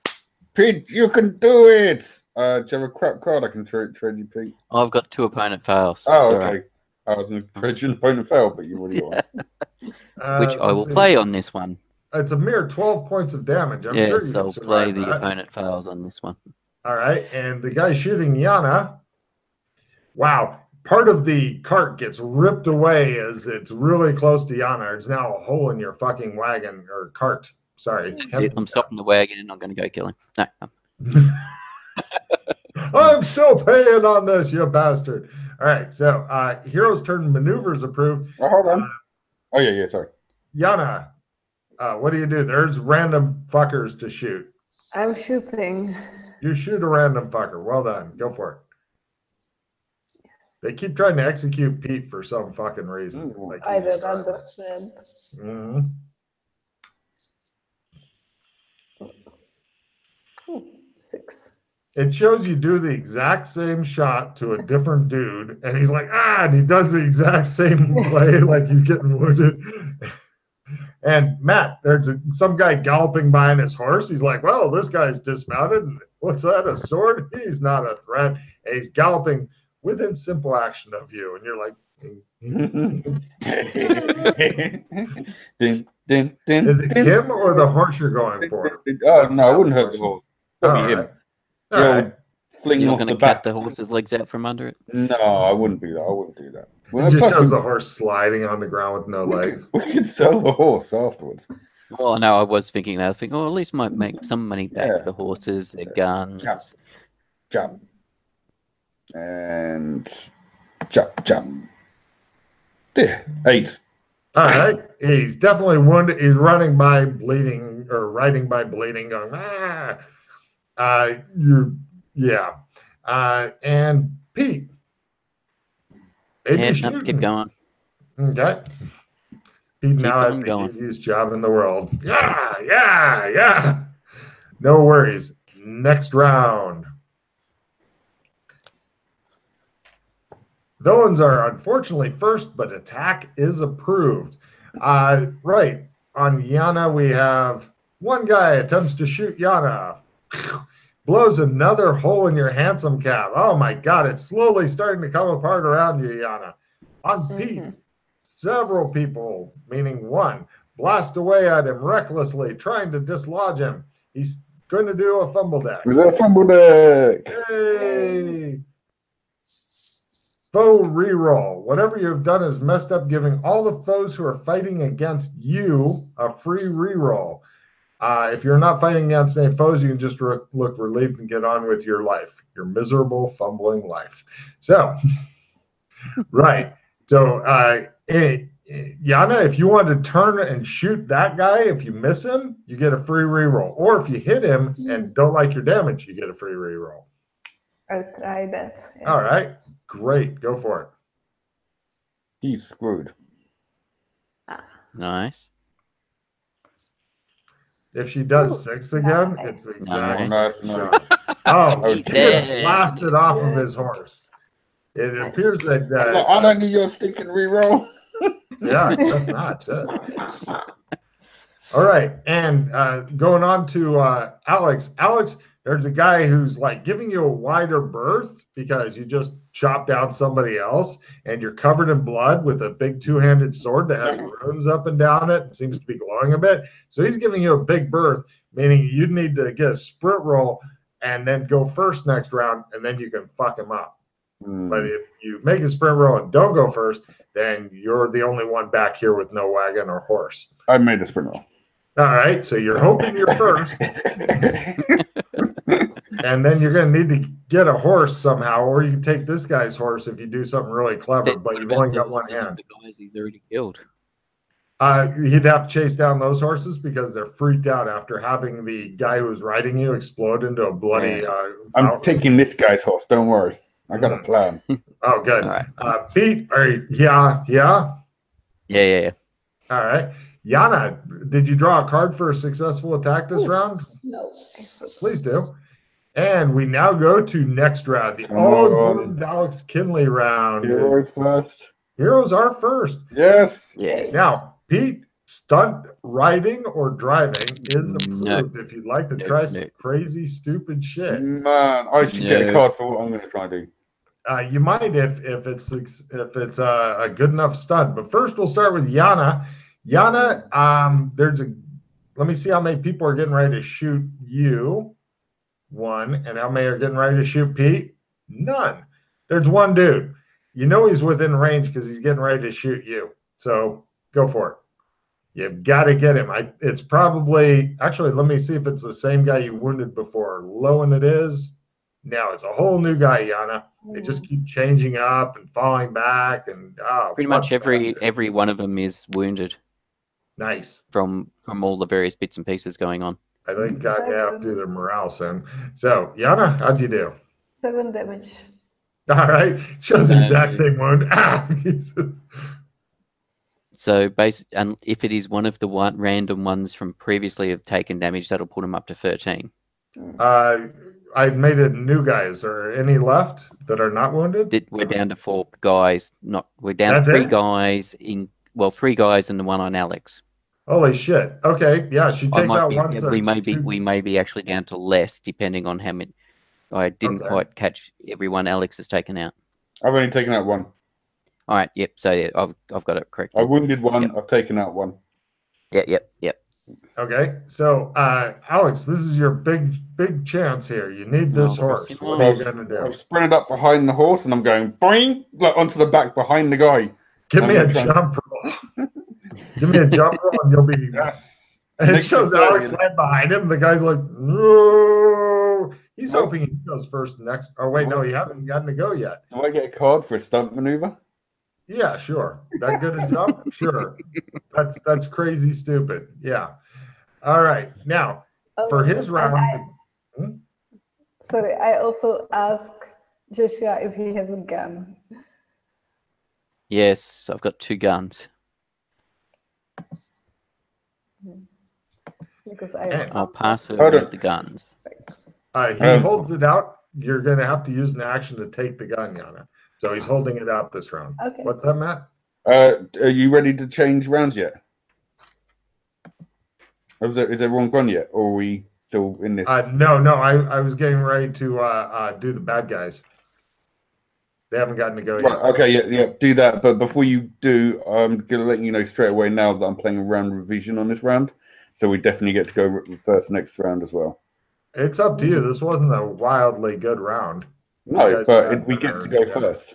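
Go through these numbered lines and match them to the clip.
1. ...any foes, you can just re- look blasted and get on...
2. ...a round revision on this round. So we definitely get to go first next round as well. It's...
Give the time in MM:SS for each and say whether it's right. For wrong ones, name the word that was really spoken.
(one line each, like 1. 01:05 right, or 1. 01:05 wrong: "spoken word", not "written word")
1. 02:59 wrong: "relieved", not "blasted"
2. 07:39 right.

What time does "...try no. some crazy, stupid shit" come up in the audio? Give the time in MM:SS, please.
04:59.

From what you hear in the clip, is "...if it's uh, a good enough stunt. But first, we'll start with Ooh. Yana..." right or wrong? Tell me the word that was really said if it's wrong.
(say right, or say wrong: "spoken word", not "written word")
wrong: "Yana", not "Ooh".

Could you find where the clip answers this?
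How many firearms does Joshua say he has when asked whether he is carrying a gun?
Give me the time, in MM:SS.
07:07.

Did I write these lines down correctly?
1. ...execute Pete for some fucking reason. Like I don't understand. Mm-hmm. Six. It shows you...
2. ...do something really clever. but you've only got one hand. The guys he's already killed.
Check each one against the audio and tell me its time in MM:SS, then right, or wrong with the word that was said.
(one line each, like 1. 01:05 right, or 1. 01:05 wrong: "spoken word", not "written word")
1. 00:51 right
2. 04:20 right.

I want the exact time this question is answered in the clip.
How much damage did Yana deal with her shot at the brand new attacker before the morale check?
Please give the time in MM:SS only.
05:47.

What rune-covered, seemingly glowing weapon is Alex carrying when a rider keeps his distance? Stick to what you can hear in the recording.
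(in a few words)
Two handed sword.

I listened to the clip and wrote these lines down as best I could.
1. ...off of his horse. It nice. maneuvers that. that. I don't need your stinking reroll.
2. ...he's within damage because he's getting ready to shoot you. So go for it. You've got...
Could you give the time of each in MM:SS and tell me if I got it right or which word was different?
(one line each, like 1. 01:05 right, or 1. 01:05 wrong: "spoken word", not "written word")
1. 03:33 wrong: "appears", not "maneuvers"
2. 05:20 wrong: "range", not "damage".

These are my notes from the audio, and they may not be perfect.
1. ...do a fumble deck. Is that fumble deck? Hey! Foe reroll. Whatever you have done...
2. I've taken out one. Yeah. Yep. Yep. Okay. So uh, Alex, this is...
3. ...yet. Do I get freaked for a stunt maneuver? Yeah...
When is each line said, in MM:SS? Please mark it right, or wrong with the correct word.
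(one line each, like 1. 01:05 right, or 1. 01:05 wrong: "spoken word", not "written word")
1. 02:44 right
2. 06:24 right
3. 06:48 wrong: "called", not "freaked".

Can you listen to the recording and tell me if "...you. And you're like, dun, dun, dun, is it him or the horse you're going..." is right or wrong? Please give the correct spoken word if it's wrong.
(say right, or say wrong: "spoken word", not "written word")
right.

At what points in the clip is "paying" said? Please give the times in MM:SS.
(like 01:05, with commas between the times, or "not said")
00:33.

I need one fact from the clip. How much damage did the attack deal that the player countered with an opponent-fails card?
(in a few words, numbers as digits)
12.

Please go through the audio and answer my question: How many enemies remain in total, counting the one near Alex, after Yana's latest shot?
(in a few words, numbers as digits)
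4.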